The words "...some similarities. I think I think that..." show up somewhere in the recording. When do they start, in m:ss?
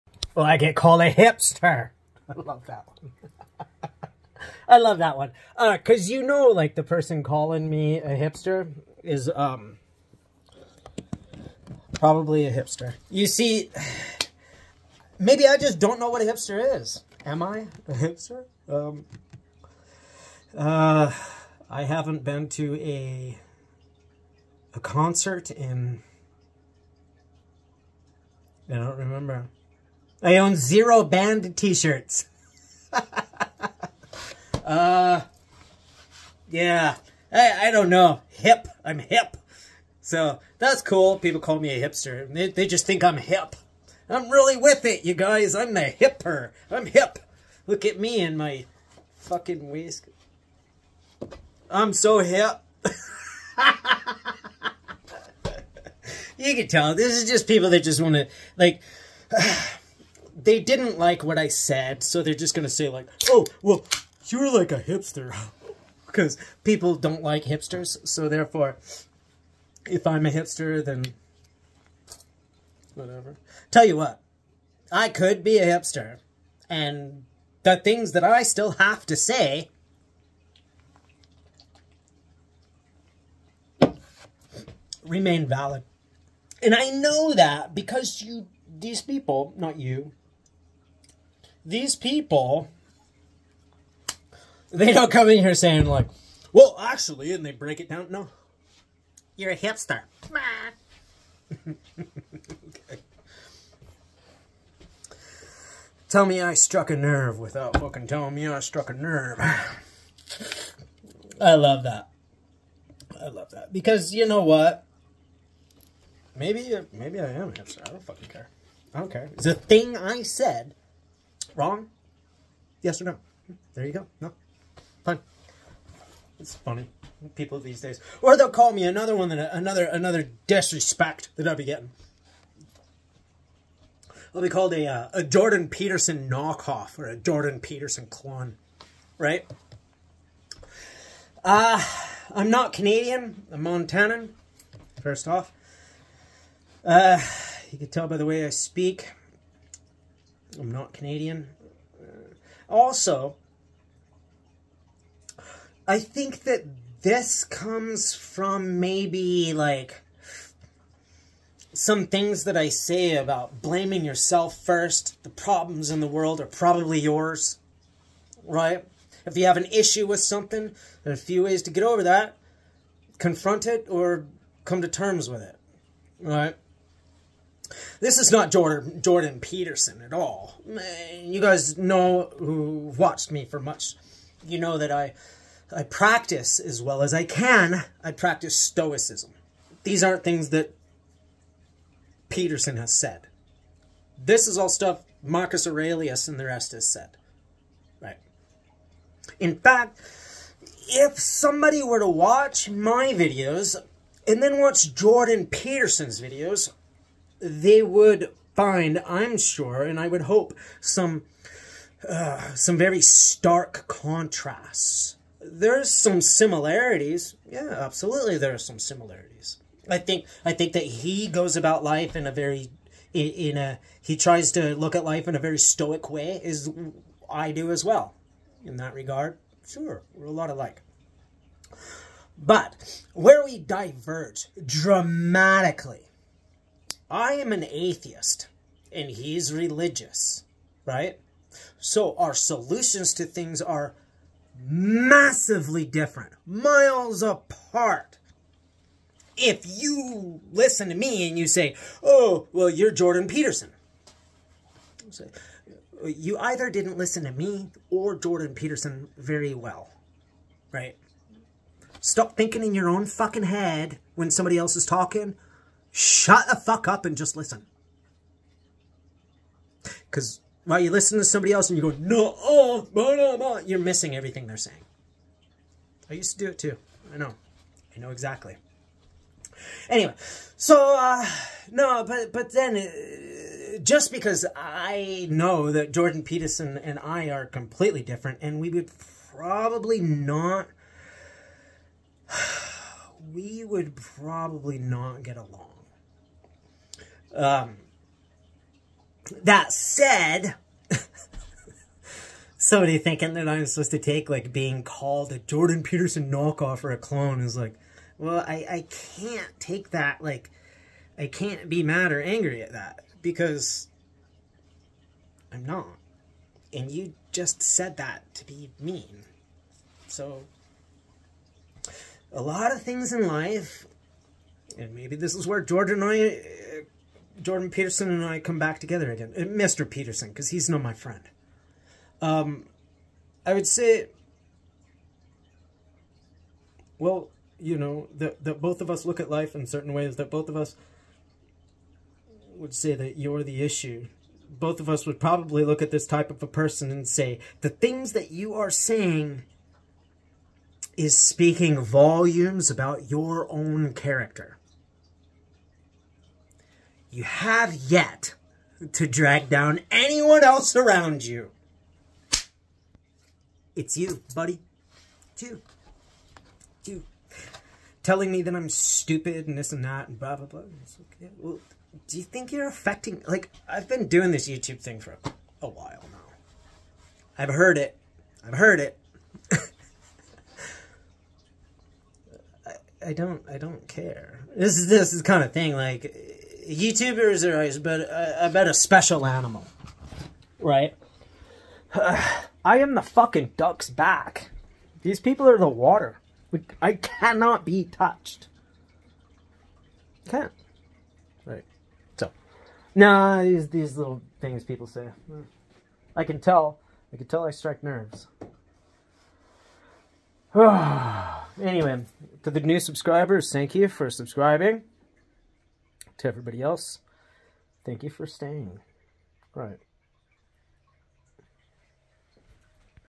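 3:38.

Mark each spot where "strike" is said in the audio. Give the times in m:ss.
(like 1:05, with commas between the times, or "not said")
6:47.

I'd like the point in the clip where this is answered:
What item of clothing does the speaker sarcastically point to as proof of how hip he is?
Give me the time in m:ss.
0:49.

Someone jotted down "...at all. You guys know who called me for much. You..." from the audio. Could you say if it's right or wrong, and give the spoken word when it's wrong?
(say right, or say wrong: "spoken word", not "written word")
wrong: "watched", not "called".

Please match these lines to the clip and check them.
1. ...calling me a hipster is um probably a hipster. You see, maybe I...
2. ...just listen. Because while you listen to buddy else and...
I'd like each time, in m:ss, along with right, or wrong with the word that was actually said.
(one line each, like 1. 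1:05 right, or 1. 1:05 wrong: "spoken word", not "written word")
1. 0:07 right
2. 4:27 wrong: "somebody", not "buddy".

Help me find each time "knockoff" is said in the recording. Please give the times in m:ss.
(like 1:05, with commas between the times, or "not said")
2:16, 5:06.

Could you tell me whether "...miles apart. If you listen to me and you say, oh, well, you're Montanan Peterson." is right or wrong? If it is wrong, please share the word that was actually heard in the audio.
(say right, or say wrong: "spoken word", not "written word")
wrong: "Jordan", not "Montanan".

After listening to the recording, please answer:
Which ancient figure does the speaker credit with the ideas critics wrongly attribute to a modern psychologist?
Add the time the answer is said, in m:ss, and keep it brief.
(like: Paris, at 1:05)
Marcus Aurelius, at 3:15.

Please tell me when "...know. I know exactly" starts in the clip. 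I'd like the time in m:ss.
4:37.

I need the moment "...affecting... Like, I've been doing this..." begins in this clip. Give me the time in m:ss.
6:12.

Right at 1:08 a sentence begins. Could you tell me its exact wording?
So therefore, if I'm a hipster, then whatever.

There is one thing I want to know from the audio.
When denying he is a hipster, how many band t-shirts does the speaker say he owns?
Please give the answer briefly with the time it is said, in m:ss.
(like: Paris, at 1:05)
0, at 0:30.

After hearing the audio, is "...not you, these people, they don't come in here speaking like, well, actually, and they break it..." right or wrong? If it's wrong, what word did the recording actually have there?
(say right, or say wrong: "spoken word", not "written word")
wrong: "saying", not "speaking".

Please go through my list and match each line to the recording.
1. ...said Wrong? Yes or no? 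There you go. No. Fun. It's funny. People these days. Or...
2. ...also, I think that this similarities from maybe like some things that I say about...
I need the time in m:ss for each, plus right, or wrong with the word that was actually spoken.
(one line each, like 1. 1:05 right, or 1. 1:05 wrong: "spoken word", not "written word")
1. 2:00 right
2. 2:32 wrong: "comes", not "similarities".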